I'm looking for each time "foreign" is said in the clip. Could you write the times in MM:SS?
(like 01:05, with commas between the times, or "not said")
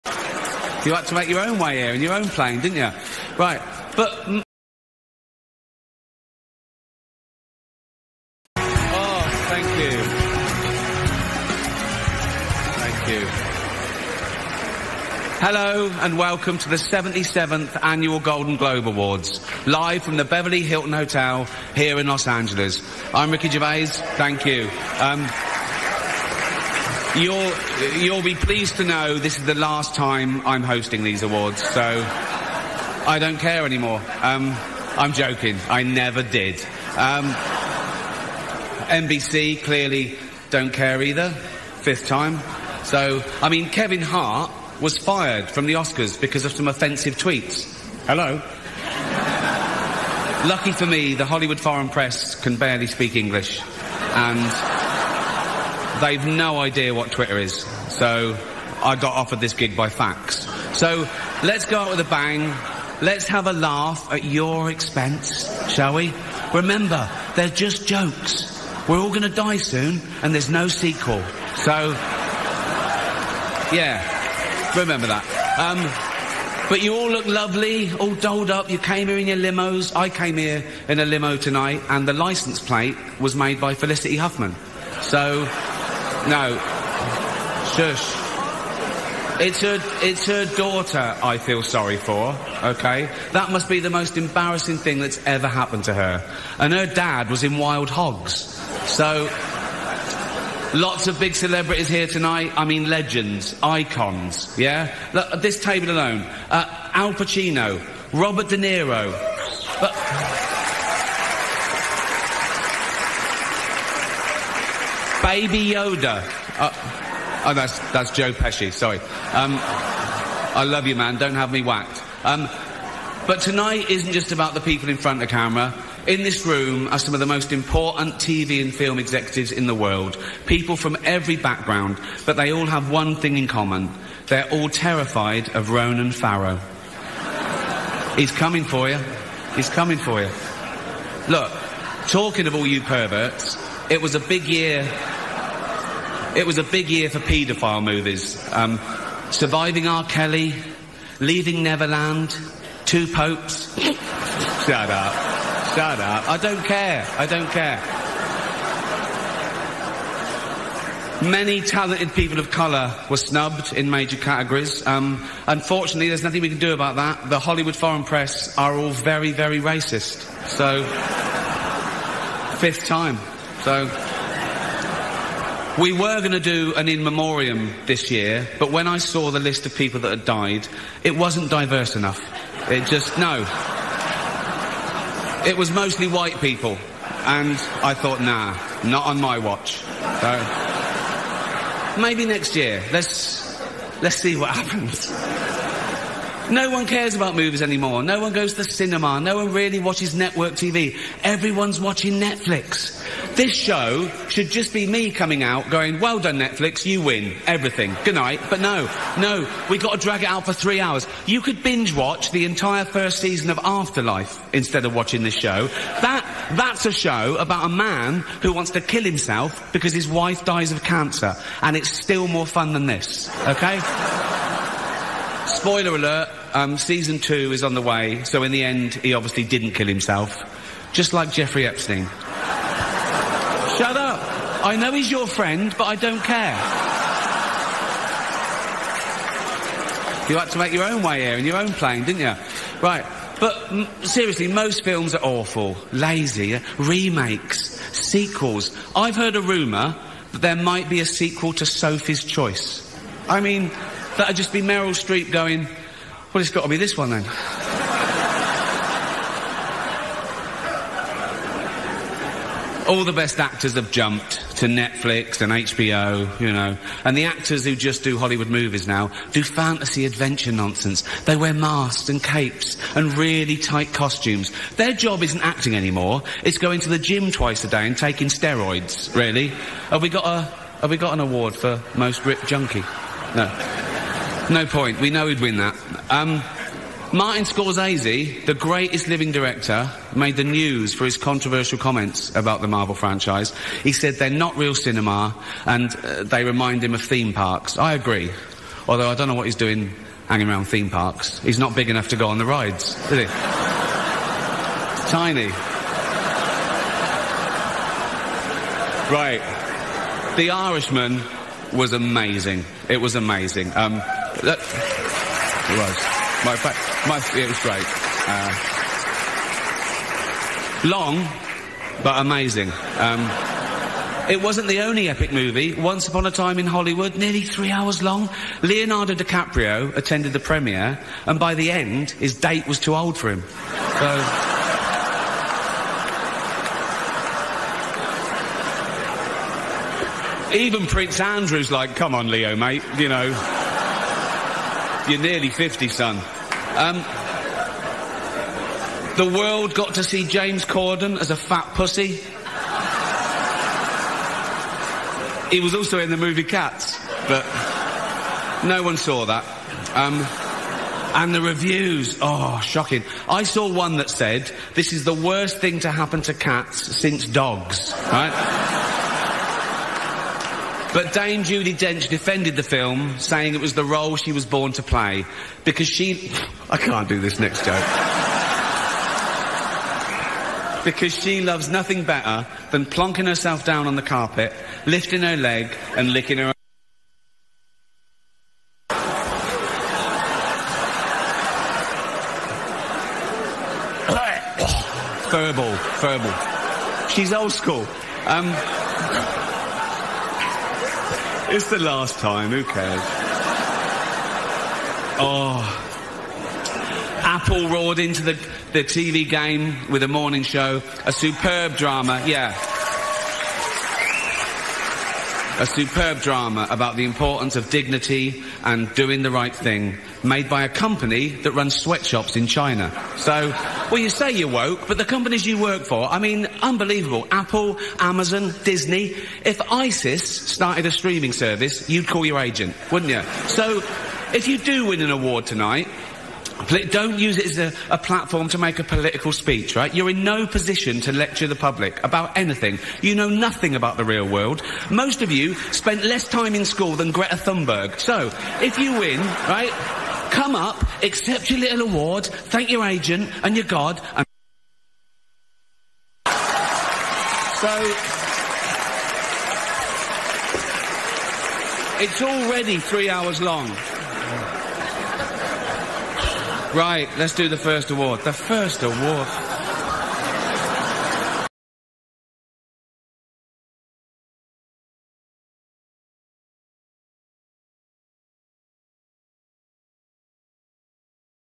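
00:51, 02:47.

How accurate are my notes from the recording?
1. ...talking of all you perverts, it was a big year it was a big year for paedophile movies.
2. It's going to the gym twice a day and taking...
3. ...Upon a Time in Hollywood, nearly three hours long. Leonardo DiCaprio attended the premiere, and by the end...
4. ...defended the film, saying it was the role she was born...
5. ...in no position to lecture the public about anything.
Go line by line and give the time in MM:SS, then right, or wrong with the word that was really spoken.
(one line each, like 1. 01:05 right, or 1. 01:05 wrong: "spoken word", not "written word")
1. 02:22 right
2. 04:36 right
3. 05:26 right
4. 06:12 right
5. 07:20 right.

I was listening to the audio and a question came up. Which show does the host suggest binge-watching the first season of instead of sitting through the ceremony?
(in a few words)
Afterlife.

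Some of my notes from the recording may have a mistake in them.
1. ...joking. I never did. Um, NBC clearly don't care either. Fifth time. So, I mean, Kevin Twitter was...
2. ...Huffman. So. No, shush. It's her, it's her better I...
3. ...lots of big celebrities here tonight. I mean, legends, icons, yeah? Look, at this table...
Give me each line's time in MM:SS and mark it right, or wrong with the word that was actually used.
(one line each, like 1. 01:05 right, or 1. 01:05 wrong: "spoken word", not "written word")
1. 00:35 wrong: "Hart", not "Twitter"
2. 01:24 wrong: "daughter", not "better"
3. 01:40 right.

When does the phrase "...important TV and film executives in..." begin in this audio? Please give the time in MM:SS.
02:07.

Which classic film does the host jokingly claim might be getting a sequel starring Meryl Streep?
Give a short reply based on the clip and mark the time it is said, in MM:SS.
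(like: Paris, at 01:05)
Sophie's Choice, at 04:11.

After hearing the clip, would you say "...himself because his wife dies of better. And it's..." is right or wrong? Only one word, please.
wrong.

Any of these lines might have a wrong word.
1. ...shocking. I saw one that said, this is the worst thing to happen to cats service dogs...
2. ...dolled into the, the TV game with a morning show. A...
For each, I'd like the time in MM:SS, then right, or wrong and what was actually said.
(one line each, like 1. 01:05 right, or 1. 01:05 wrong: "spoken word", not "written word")
1. 06:02 wrong: "since", not "service"
2. 06:47 wrong: "roared", not "dolled".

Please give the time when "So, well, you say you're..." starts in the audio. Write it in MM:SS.
07:03.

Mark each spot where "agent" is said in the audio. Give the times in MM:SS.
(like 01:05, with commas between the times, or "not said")
07:12, 07:32.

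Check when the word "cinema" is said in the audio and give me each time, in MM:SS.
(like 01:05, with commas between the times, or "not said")
03:18, 04:54.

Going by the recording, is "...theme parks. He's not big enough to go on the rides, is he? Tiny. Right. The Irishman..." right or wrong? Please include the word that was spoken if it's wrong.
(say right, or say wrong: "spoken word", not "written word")
right.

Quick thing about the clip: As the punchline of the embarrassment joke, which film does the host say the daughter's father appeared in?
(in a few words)
Wild Hogs.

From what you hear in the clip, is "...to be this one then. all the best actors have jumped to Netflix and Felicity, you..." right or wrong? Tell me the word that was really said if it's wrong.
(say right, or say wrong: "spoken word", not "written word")
wrong: "HBO", not "Felicity".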